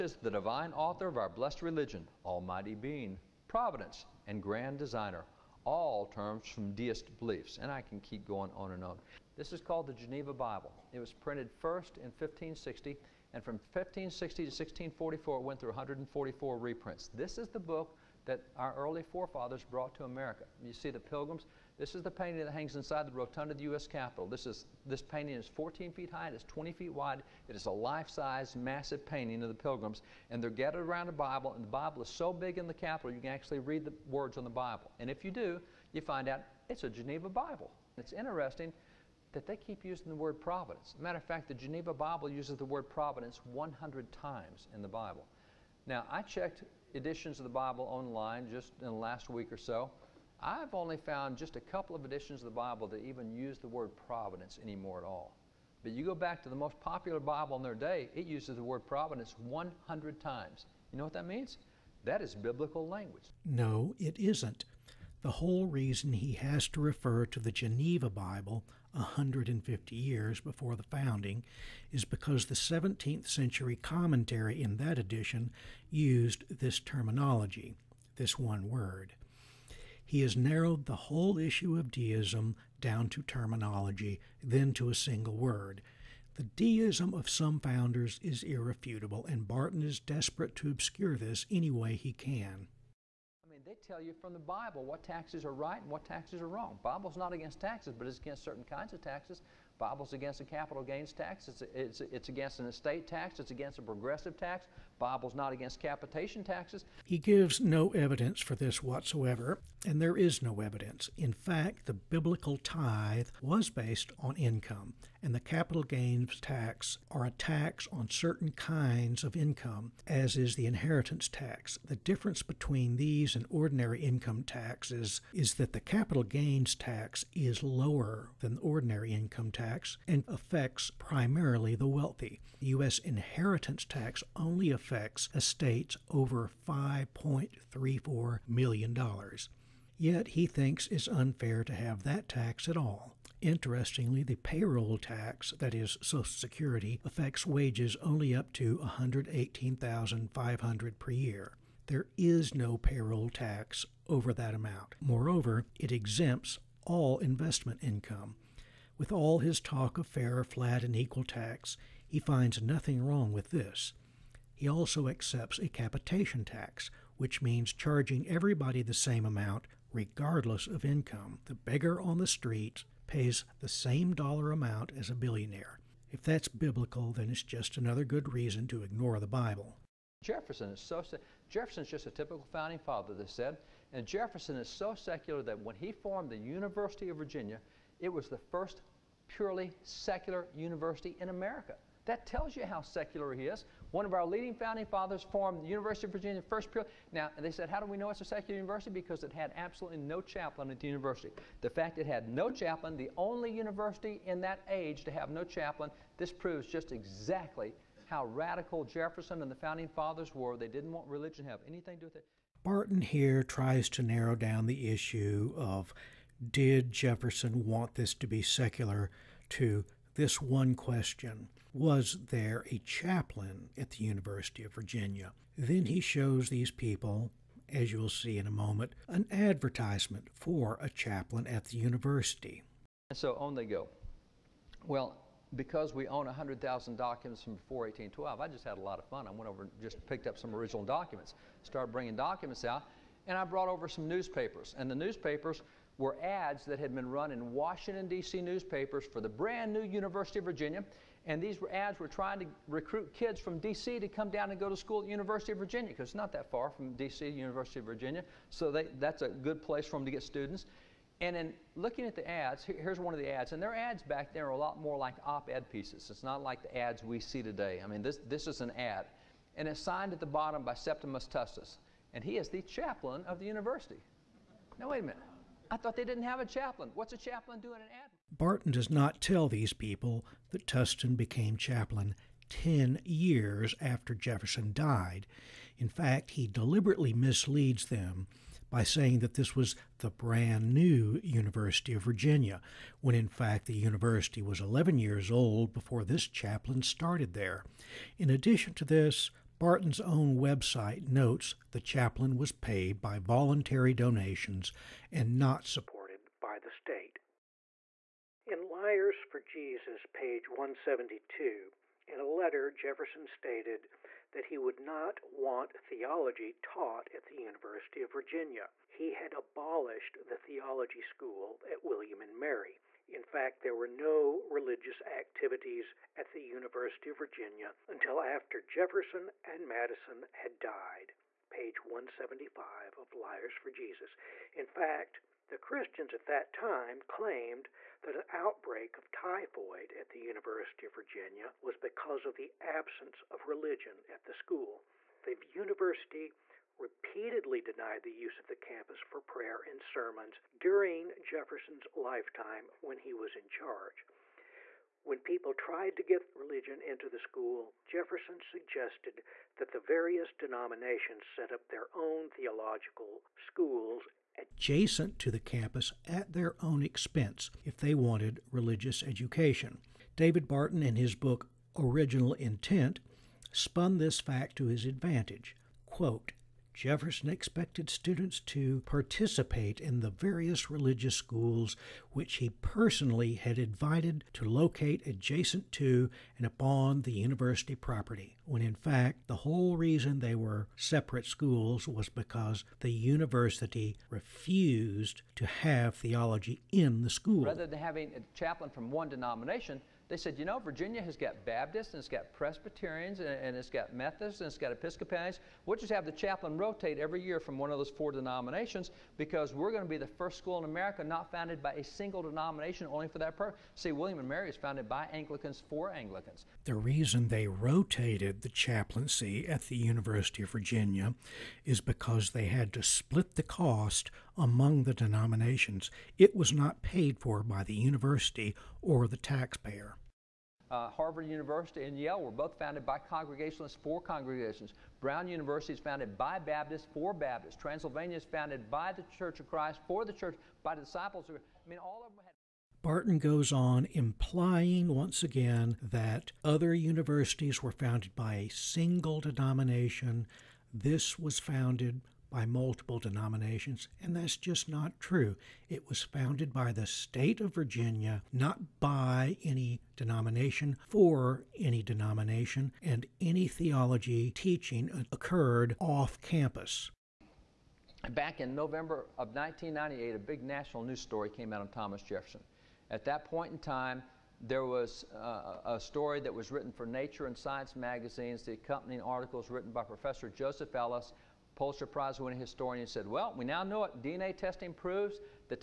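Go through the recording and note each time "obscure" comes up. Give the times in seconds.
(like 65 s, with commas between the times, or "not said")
90 s.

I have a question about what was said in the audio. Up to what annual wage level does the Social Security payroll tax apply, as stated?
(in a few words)
$118,500.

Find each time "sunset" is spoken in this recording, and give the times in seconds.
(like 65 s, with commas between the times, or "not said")
not said.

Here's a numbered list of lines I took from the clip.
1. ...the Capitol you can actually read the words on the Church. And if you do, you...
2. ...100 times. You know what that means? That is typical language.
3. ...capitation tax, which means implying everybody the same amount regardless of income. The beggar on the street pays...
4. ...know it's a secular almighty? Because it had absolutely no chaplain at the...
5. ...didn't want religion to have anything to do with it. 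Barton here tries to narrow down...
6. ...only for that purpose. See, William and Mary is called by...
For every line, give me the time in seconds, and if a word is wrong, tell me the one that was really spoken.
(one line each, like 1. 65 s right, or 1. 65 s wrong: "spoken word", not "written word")
1. 32 s wrong: "Bible", not "Church"
2. 59 s wrong: "biblical", not "typical"
3. 165 s wrong: "charging", not "implying"
4. 197 s wrong: "university", not "almighty"
5. 210 s right
6. 412 s wrong: "founded", not "called".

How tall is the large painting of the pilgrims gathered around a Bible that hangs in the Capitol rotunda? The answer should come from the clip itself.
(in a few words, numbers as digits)
14 feet.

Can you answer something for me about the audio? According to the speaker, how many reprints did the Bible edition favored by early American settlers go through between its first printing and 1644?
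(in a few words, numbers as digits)
144.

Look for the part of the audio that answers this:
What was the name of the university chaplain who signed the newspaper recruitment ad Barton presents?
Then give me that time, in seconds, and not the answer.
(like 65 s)
270 s.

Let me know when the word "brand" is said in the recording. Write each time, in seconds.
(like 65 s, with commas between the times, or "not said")
249 s, 290 s.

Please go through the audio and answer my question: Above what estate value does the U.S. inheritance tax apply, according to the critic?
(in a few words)
$5.34 million.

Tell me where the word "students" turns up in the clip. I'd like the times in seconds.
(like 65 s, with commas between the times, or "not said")
260 s, 377 s.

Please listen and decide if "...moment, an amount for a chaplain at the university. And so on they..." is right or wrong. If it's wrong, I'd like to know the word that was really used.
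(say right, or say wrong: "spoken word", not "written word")
wrong: "advertisement", not "amount".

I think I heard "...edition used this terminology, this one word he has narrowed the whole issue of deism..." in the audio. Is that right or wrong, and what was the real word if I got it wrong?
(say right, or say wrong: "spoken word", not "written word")
right.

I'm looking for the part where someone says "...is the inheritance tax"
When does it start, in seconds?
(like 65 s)
120 s.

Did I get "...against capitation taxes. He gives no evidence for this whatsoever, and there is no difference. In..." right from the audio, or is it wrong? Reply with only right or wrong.
wrong.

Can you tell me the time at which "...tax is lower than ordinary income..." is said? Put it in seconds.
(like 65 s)
126 s.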